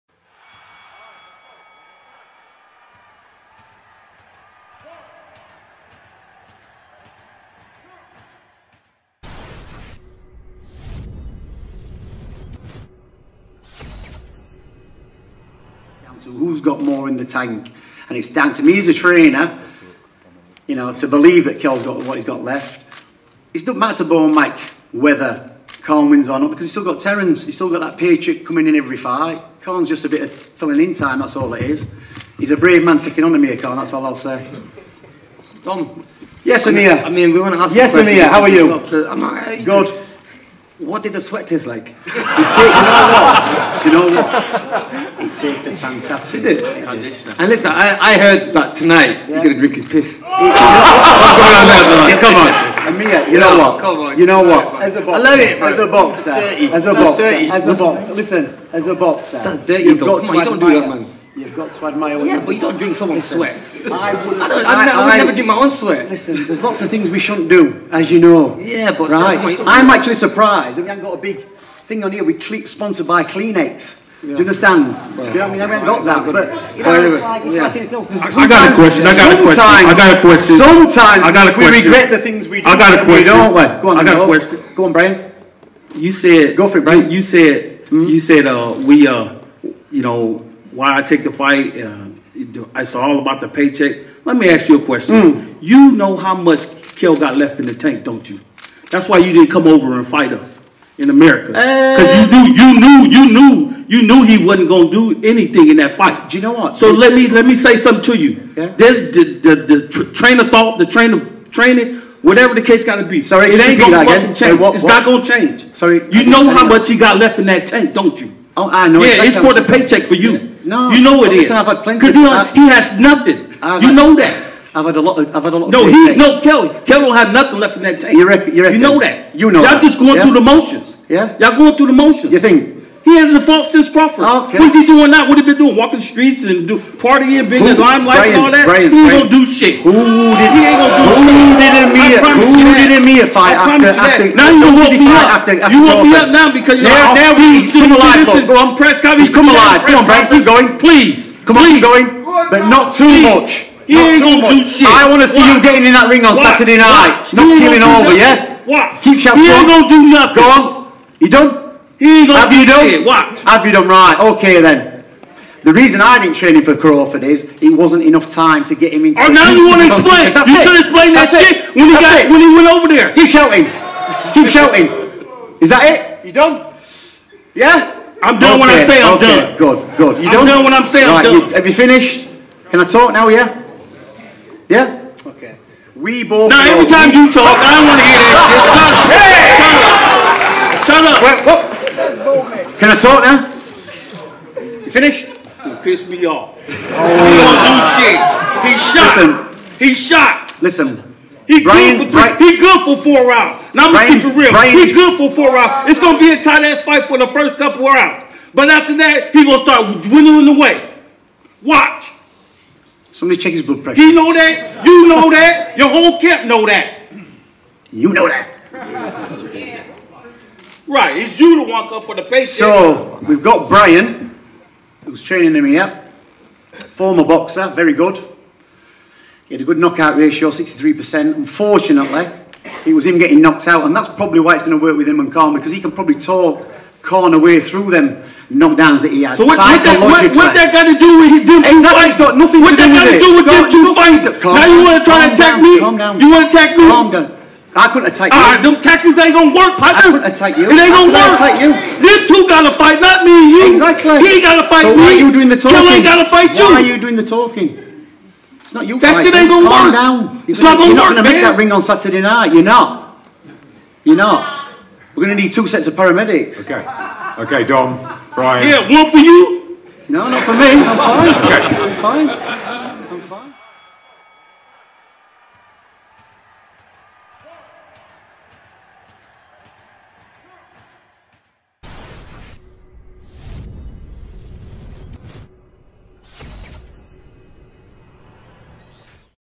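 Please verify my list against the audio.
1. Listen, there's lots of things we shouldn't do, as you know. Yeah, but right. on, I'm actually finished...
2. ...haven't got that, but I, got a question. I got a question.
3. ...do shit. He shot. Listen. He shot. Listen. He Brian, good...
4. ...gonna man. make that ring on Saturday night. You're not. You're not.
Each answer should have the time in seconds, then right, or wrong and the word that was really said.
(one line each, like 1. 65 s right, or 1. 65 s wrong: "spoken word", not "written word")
1. 66 s wrong: "surprised", not "finished"
2. 75 s right
3. 198 s right
4. 261 s right.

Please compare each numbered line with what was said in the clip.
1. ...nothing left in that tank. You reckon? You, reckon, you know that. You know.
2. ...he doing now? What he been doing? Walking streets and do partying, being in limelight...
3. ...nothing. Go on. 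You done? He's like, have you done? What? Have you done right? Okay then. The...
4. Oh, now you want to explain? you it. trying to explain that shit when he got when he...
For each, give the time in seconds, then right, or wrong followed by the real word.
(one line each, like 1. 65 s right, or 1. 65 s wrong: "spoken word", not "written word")
1. 127 s right
2. 134 s right
3. 160 s right
4. 169 s right.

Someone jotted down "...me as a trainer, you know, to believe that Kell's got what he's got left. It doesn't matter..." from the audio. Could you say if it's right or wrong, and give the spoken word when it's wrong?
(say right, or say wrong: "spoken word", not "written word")
right.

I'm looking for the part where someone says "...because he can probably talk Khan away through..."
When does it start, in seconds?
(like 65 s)
235 s.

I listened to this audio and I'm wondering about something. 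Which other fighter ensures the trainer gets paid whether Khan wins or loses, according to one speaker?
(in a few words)
Terence.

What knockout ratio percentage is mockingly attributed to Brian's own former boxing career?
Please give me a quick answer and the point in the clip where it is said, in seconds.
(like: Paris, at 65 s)
63%, at 230 s.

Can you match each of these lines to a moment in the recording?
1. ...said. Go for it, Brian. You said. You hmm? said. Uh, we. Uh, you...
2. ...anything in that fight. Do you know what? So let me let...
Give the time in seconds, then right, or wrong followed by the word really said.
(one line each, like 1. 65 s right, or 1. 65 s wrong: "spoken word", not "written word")
1. 86 s right
2. 105 s right.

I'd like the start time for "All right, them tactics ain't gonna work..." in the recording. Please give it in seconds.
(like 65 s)
248 s.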